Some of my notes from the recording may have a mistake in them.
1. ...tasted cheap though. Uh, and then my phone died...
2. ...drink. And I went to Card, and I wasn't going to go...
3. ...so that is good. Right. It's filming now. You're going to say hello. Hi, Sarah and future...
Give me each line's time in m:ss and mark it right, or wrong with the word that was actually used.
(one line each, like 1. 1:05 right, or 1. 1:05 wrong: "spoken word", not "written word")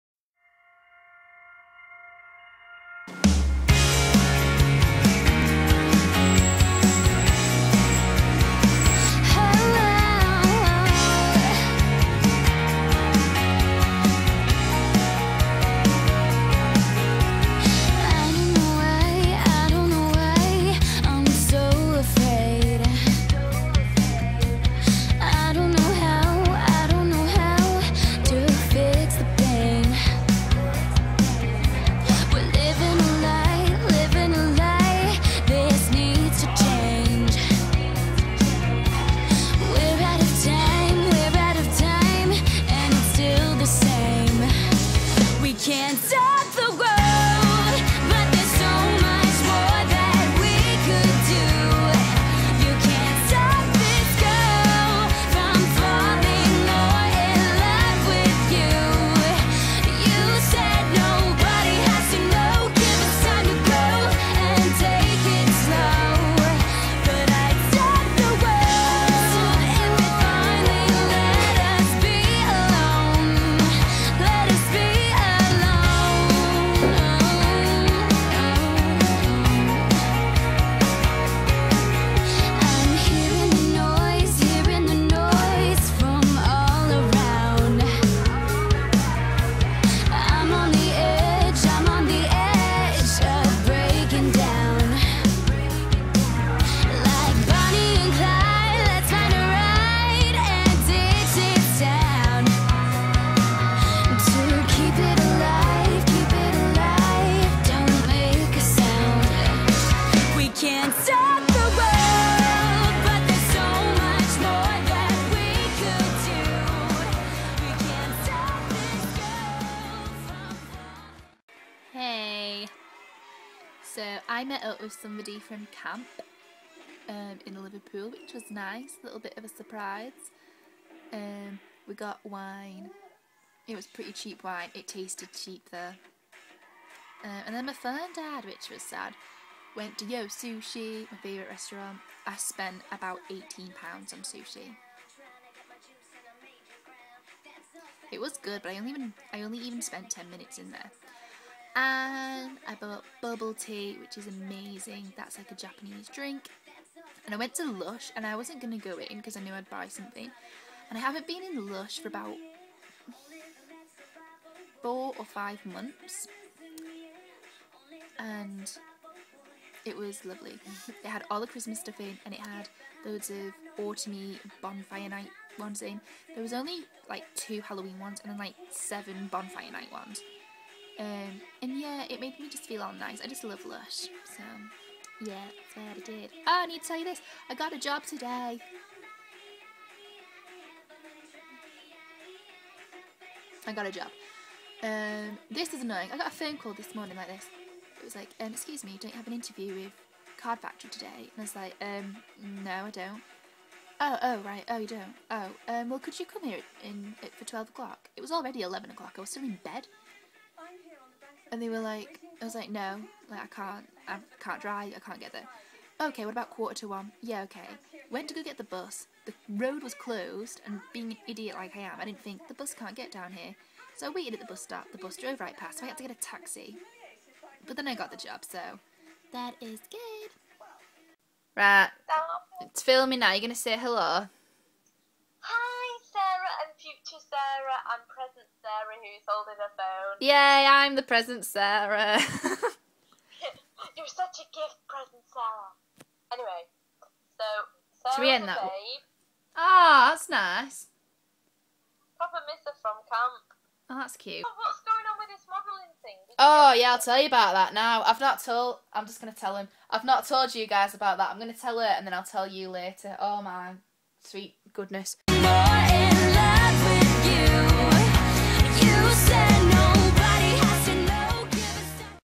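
1. 2:14 right
2. 2:36 wrong: "Lush", not "Card"
3. 3:48 right.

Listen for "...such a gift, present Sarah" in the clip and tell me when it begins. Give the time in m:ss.
4:04.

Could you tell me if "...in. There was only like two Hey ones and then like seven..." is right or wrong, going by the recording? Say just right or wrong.
wrong.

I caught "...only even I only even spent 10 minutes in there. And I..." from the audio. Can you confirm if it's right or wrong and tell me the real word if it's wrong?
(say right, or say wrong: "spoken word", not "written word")
right.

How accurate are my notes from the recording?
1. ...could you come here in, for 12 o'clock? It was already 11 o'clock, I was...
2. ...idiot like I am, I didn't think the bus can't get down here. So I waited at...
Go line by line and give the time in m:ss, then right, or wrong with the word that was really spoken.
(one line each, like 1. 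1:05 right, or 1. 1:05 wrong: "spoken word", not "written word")
1. 3:25 right
2. 3:41 right.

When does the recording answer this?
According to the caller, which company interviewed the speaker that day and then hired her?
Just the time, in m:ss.
3:20.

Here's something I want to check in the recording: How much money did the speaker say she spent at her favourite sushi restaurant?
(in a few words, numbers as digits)
£18.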